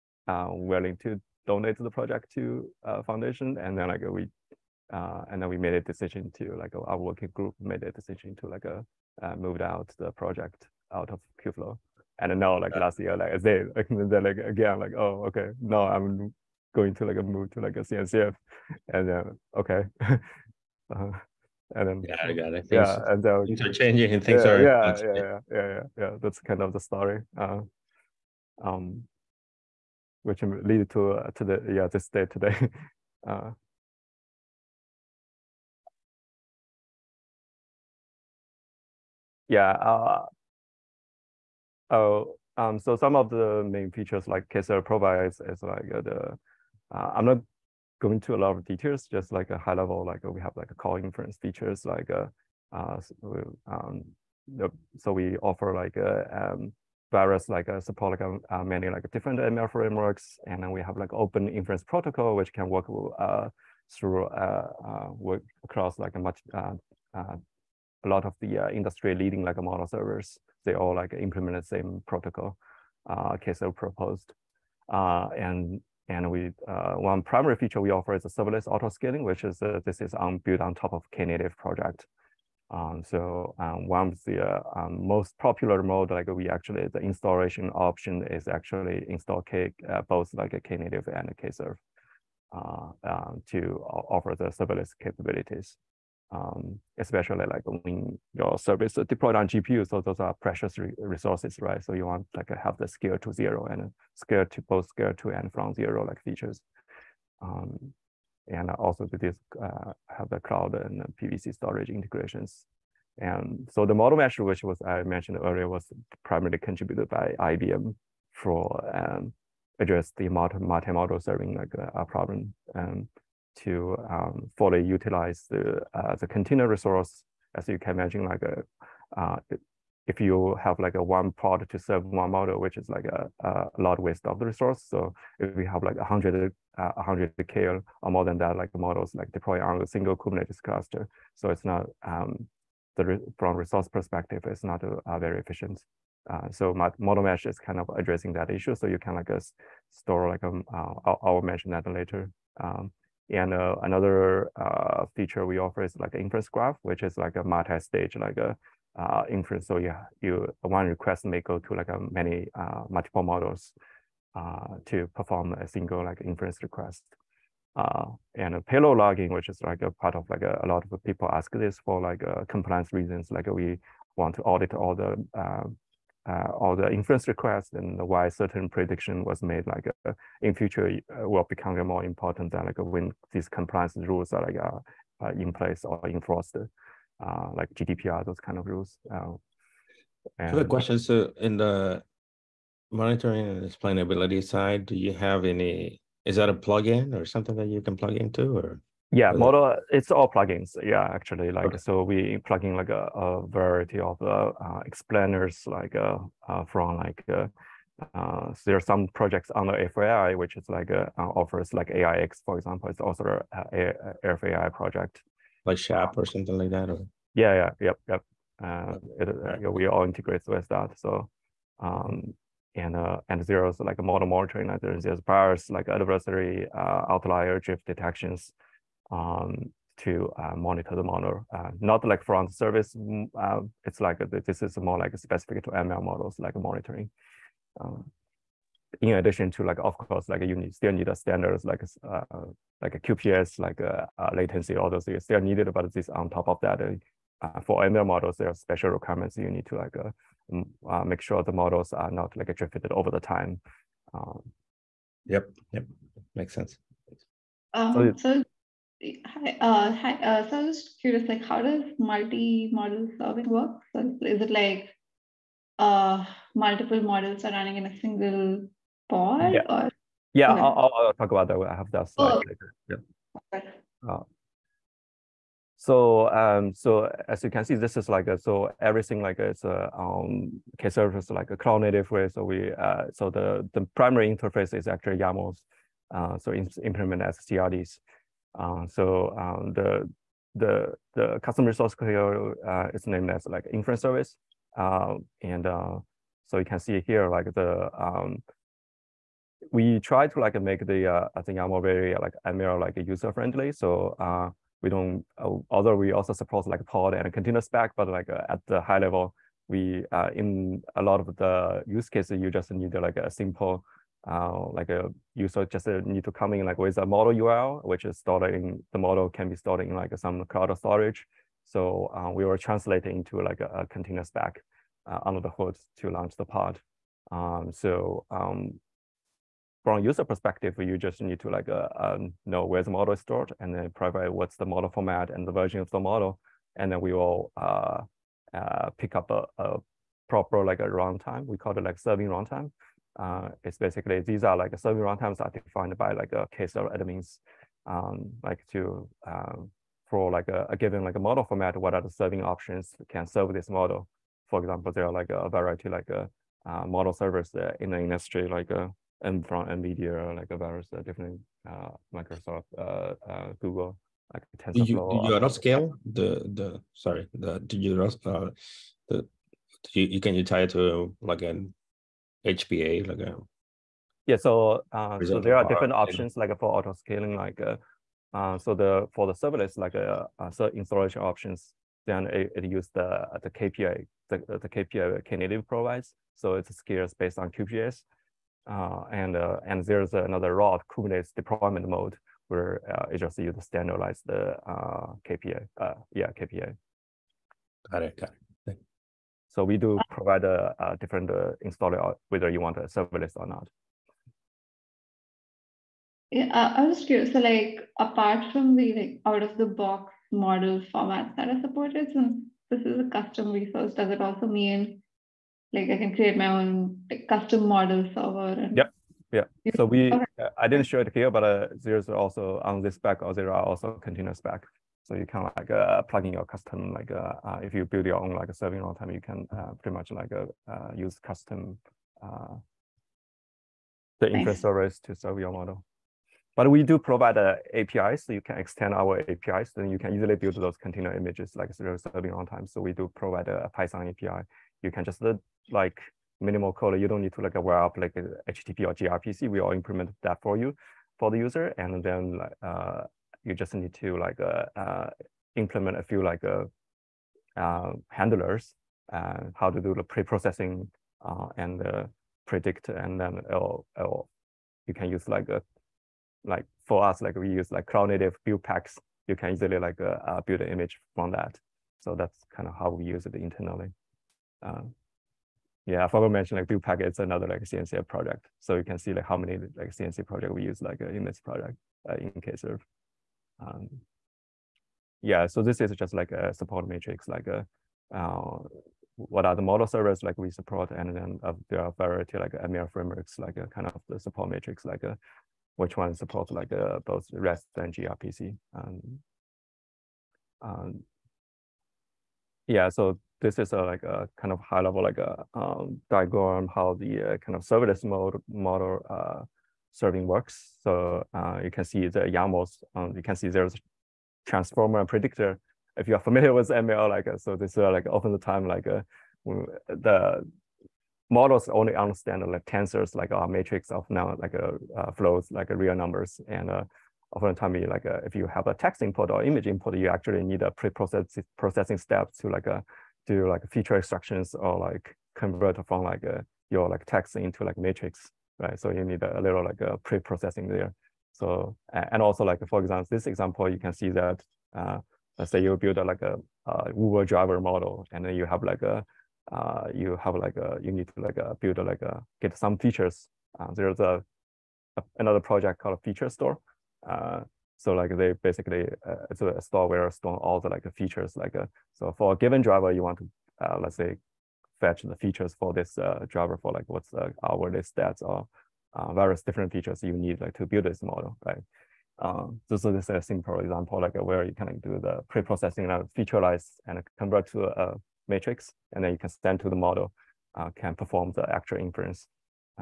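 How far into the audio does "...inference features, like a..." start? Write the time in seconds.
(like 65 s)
50 s.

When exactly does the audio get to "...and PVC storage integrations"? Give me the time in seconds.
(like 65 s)
110 s.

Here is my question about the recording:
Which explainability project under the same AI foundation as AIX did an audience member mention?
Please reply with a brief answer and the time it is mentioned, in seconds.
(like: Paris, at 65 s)
SHAP, at 215 s.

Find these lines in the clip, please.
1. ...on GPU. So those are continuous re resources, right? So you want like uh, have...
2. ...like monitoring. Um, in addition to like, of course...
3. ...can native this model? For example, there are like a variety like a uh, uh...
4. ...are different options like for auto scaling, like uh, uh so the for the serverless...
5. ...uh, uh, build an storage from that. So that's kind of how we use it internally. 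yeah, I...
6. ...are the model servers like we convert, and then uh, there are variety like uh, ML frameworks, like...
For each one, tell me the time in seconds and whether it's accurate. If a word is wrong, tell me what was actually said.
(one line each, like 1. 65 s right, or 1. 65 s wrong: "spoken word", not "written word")
1. 99 s wrong: "precious", not "continuous"
2. 236 s right
3. 353 s wrong: "serve", not "native"
4. 375 s right
5. 470 s wrong: "image", not "storage"
6. 489 s wrong: "support", not "convert".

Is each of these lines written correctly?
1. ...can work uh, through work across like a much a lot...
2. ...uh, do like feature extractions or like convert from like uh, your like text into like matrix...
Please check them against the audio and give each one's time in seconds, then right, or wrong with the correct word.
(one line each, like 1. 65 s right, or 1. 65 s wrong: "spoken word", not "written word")
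1. 62 s right
2. 532 s right.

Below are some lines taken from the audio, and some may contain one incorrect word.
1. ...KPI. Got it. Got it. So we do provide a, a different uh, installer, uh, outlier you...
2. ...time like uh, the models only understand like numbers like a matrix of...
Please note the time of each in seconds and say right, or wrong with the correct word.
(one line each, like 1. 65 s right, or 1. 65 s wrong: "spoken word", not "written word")
1. 396 s wrong: "whether", not "outlier"
2. 518 s wrong: "tensors", not "numbers".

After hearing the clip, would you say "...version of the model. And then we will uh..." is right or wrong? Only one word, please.
right.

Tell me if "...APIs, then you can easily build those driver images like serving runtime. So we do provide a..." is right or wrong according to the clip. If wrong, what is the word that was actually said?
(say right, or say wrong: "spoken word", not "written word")
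wrong: "container", not "driver".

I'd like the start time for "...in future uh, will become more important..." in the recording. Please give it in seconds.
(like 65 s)
180 s.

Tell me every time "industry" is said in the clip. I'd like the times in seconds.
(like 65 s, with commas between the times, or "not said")
68 s, 357 s.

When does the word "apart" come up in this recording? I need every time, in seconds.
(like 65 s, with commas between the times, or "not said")
407 s.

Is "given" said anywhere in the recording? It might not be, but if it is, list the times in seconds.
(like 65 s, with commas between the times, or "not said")
350 s, 562 s.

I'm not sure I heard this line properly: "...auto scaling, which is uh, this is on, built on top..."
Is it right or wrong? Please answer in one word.
right.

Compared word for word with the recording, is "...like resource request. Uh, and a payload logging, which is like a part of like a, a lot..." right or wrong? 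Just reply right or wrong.
wrong.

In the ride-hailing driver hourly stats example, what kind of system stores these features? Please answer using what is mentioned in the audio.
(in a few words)
feature store.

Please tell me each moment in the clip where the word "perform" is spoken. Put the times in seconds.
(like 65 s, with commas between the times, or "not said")
165 s, 580 s.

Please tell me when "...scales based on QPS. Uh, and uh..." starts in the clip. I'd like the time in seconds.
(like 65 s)
386 s.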